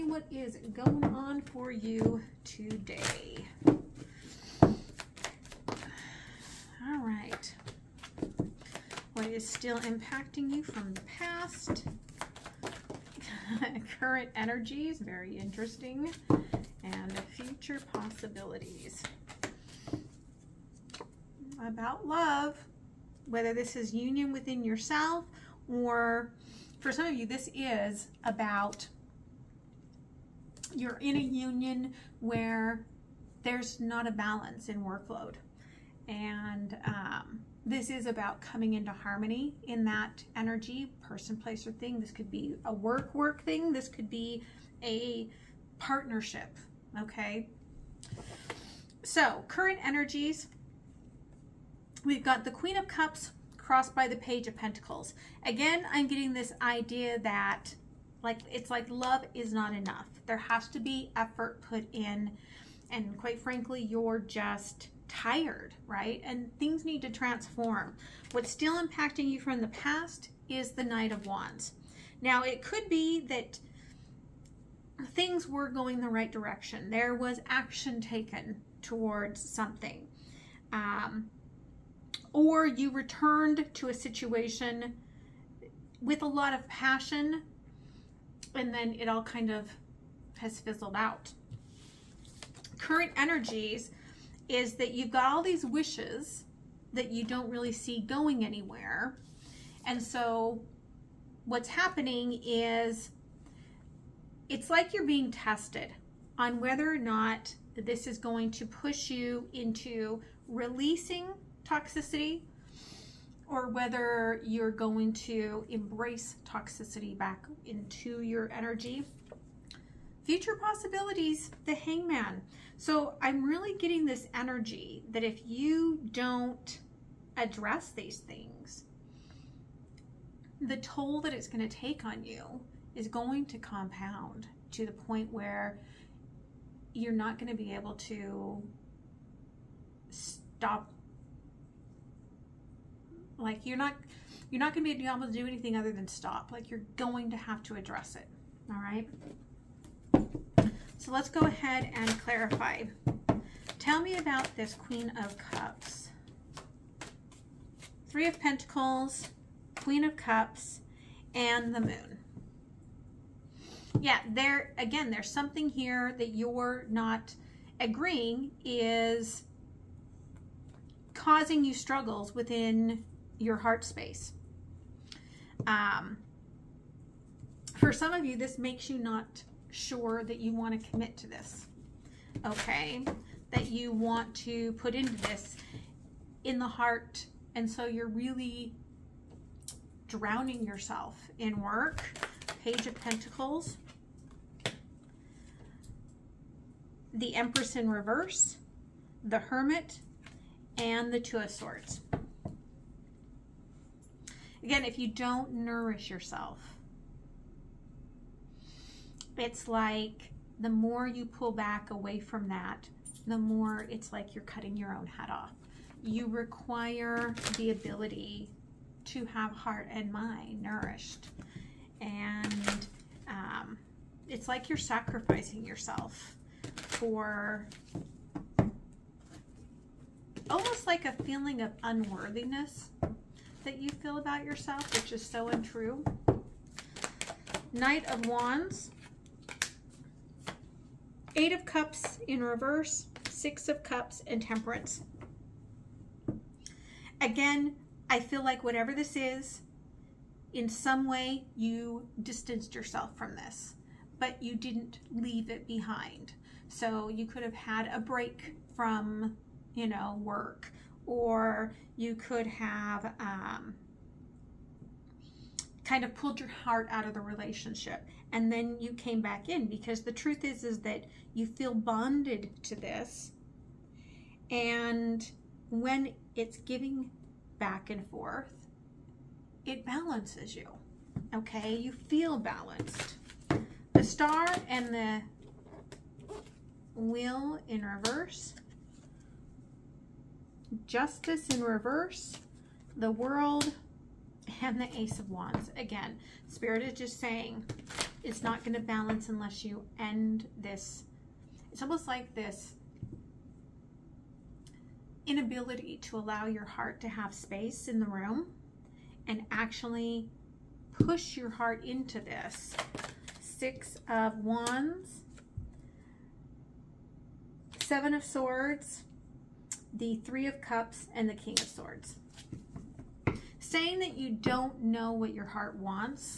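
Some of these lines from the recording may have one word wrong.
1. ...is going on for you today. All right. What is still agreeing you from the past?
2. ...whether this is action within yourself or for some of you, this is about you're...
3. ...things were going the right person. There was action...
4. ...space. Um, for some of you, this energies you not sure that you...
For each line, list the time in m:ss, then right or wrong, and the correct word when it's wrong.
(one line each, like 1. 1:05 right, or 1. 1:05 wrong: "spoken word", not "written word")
1. 0:00 wrong: "impacting", not "agreeing"
2. 0:23 wrong: "union", not "action"
3. 1:15 wrong: "direction", not "person"
4. 2:53 wrong: "makes", not "energies".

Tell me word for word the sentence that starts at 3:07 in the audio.
And so you're really drowning yourself in work.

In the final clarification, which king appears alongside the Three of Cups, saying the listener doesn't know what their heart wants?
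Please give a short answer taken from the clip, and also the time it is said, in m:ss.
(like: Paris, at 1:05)
King of Swords, at 5:21.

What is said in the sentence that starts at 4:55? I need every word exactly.
Again, Spirit is just saying it's not going to balance unless you end this.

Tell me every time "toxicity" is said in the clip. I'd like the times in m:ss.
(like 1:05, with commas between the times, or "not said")
1:51, 1:56.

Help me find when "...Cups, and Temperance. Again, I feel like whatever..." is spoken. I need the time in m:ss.
4:03.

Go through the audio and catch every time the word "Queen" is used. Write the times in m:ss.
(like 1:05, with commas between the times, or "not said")
0:52, 2:34, 2:39.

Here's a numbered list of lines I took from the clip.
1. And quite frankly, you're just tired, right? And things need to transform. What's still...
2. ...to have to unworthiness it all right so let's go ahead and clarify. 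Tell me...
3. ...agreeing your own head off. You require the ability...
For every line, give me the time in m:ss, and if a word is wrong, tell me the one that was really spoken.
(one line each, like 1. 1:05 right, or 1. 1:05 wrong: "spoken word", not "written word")
1. 1:02 right
2. 2:27 wrong: "address", not "unworthiness"
3. 3:34 wrong: "cutting", not "agreeing".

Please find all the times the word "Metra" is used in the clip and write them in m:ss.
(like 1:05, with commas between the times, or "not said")
not said.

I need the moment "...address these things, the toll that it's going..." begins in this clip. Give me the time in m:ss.
2:07.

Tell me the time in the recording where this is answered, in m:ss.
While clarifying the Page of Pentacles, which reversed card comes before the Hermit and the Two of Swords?
3:17.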